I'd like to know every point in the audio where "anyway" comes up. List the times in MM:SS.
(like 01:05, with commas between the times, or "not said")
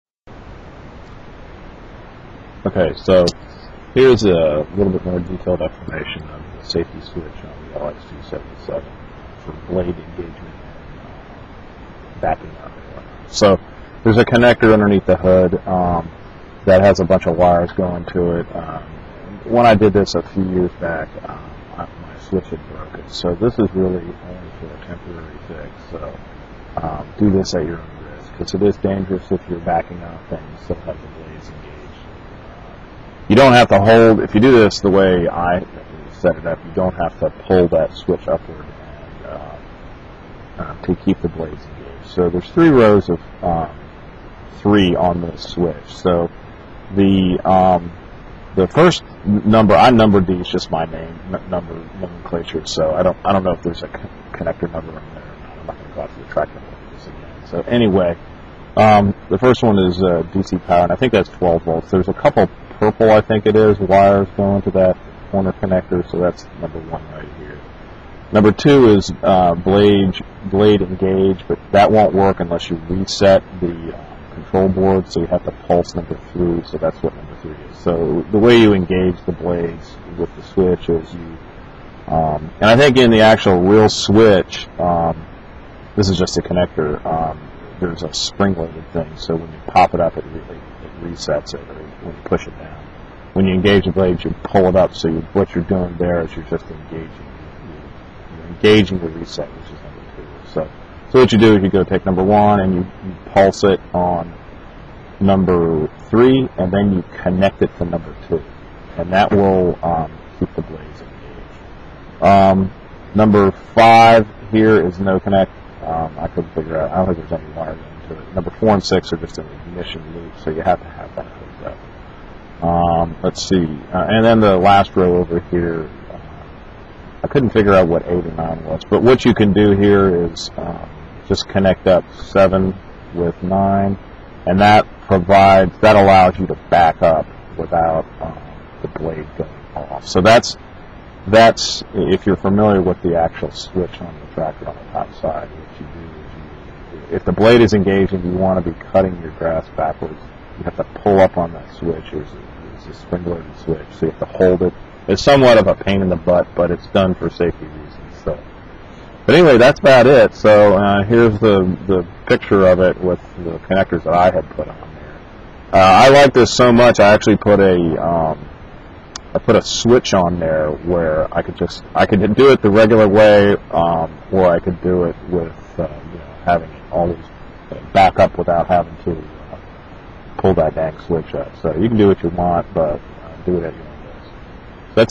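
00:57, 02:39.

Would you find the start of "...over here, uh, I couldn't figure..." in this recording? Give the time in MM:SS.
02:05.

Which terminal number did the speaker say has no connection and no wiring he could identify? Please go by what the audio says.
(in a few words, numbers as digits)
5.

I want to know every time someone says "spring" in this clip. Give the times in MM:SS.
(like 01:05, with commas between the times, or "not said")
01:28, 02:32.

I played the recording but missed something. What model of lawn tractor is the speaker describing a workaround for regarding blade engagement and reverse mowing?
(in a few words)
LX277.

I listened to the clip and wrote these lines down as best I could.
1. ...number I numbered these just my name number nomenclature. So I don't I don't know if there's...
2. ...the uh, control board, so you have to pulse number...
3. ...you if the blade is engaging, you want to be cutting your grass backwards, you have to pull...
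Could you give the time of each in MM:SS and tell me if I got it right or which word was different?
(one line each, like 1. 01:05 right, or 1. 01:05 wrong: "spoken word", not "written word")
1. 00:49 right
2. 01:13 right
3. 02:26 right.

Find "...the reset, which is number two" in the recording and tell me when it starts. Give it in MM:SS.
01:38.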